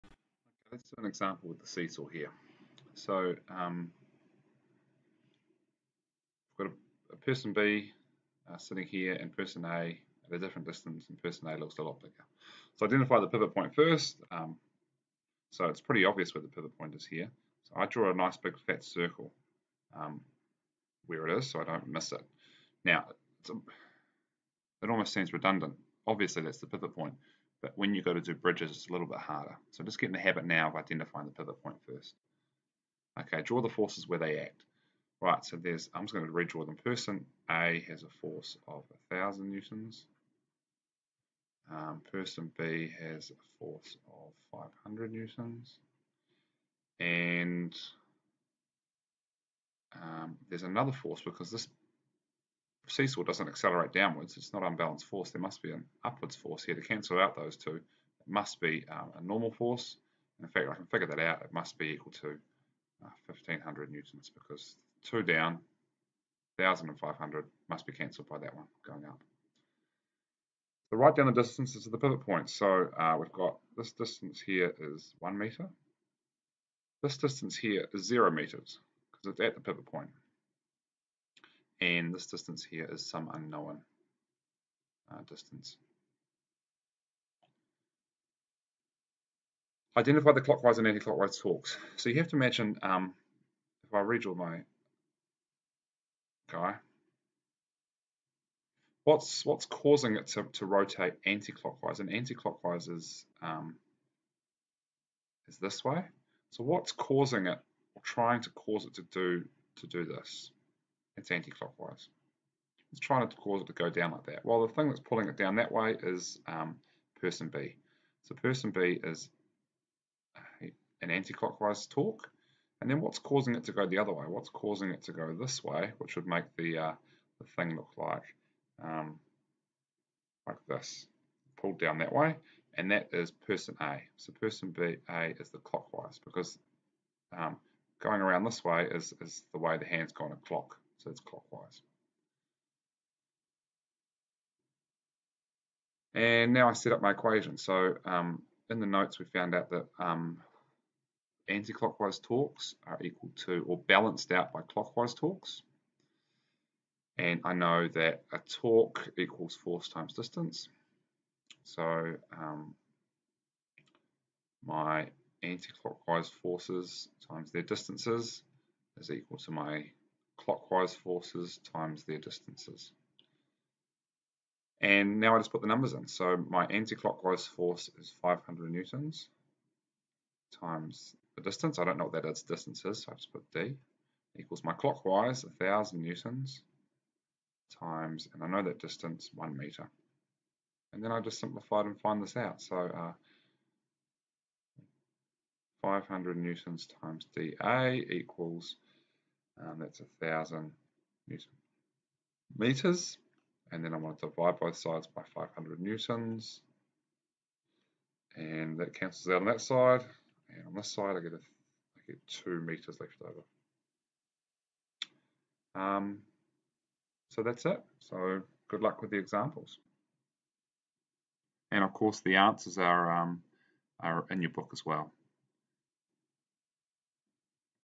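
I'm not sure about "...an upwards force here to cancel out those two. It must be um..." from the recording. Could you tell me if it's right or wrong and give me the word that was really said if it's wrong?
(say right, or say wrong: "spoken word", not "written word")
right.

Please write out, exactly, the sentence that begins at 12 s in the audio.
So identify the pivot point first.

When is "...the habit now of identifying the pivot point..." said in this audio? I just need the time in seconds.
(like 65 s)
30 s.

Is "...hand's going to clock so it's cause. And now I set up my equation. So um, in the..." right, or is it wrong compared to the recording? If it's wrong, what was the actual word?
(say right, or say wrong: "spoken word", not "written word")
wrong: "clockwise", not "cause".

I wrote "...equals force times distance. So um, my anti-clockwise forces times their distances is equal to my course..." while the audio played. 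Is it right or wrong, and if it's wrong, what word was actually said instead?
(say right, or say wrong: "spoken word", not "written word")
wrong: "clockwise", not "course".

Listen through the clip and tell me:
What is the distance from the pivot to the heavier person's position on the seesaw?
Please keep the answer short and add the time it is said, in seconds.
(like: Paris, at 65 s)
1 metre, at 75 s.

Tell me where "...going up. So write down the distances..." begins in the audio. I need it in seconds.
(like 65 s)
68 s.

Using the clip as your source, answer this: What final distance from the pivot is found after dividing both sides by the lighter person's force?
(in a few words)
2 meters.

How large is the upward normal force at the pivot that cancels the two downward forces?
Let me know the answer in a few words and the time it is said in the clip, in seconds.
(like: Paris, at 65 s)
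1500 newtons, at 63 s.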